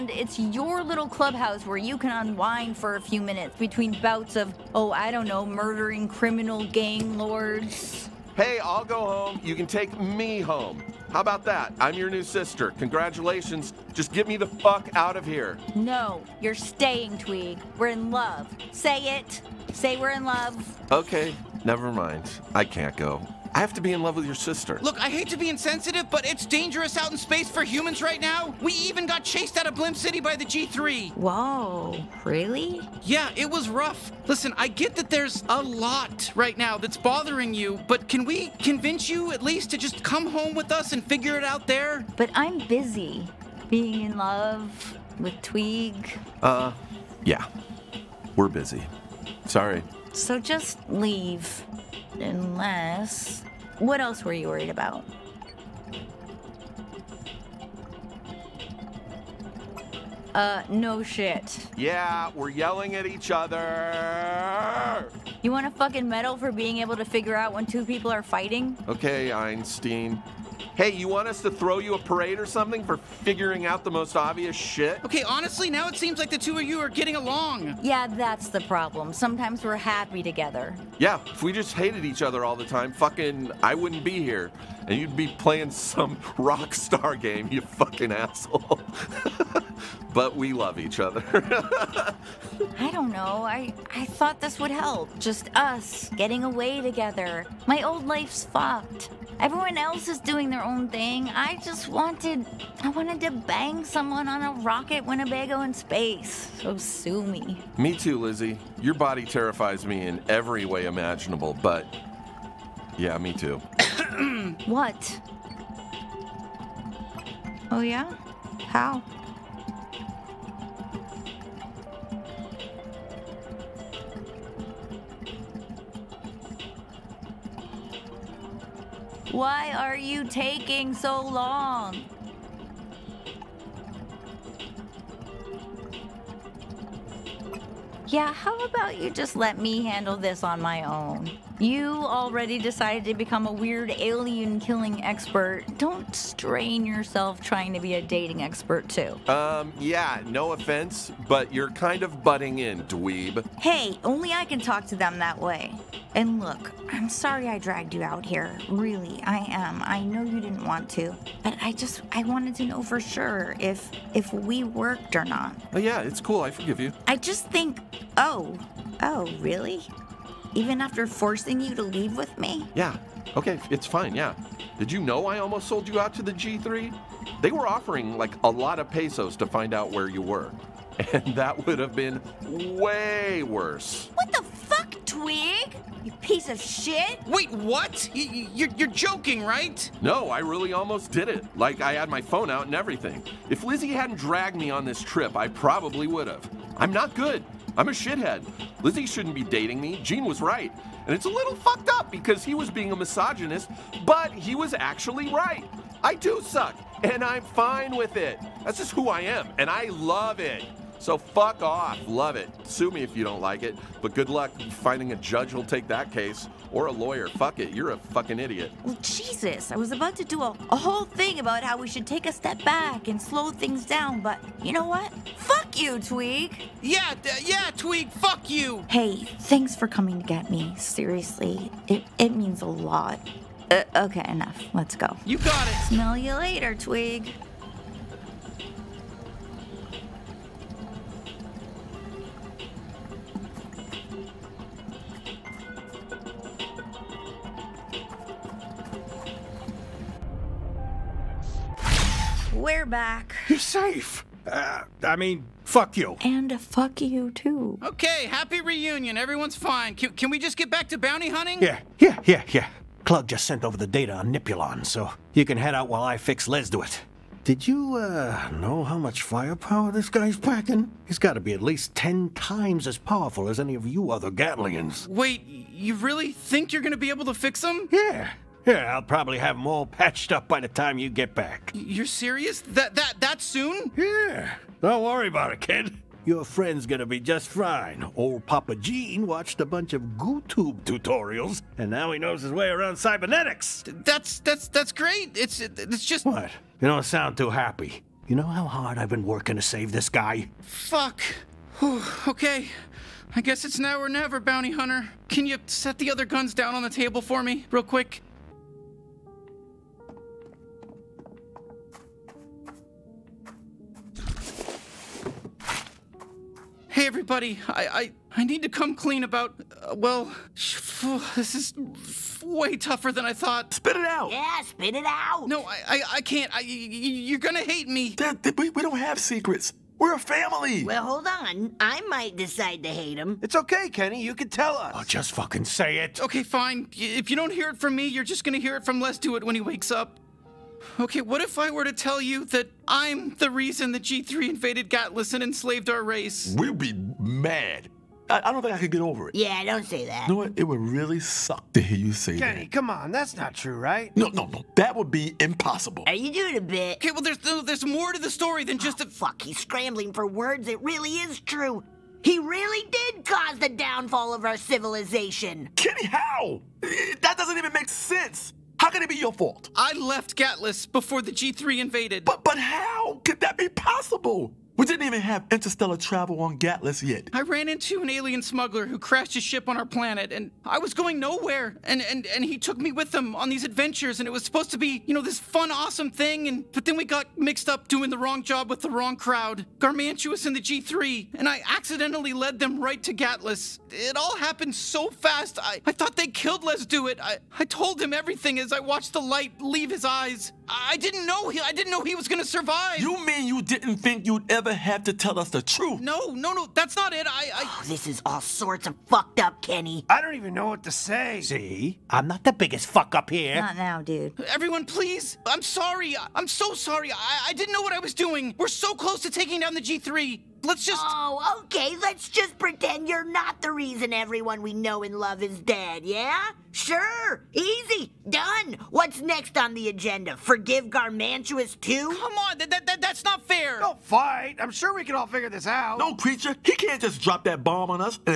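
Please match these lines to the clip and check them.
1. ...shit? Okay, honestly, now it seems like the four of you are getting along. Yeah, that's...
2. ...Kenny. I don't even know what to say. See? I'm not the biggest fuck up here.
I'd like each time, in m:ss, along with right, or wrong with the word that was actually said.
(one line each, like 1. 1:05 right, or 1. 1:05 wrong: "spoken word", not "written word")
1. 1:14 wrong: "two", not "four"
2. 6:49 right.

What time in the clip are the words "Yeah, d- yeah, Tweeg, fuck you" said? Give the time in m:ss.
3:46.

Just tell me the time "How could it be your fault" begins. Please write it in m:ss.
6:08.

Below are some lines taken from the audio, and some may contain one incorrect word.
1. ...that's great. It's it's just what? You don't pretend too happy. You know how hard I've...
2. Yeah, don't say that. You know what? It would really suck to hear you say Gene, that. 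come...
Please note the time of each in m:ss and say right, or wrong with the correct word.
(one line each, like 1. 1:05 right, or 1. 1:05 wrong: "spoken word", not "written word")
1. 4:54 wrong: "sound", not "pretend"
2. 5:49 wrong: "Kenny", not "Gene".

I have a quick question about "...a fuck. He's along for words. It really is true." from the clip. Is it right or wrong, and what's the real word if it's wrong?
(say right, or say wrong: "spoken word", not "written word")
wrong: "scrambling", not "along".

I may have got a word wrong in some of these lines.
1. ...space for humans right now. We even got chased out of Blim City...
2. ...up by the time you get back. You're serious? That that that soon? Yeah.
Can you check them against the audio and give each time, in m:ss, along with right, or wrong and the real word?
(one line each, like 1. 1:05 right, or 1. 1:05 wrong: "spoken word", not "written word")
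1. 0:27 right
2. 4:40 right.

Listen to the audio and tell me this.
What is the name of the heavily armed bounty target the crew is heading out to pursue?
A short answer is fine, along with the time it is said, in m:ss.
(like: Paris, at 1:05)
Nipulon, at 4:24.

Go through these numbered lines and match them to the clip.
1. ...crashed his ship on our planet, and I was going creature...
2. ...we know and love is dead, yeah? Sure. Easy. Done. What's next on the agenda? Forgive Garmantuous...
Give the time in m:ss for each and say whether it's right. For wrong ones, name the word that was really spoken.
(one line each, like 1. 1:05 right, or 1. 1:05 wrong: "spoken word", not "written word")
1. 6:18 wrong: "nowhere", not "creature"
2. 7:04 right.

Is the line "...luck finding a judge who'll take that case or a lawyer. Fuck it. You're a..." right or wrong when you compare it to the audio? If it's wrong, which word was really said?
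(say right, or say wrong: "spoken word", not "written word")
right.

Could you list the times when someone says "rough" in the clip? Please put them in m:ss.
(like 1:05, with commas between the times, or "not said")
0:33.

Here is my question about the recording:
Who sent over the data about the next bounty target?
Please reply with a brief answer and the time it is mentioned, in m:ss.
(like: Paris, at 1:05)
Clug, at 4:23.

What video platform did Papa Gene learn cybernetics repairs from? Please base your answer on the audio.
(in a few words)
GooTube.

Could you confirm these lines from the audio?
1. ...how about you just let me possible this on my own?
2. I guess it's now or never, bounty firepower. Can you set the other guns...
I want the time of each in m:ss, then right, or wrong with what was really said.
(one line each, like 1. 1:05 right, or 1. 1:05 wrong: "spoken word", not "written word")
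1. 2:18 wrong: "handle", not "possible"
2. 5:03 wrong: "hunter", not "firepower".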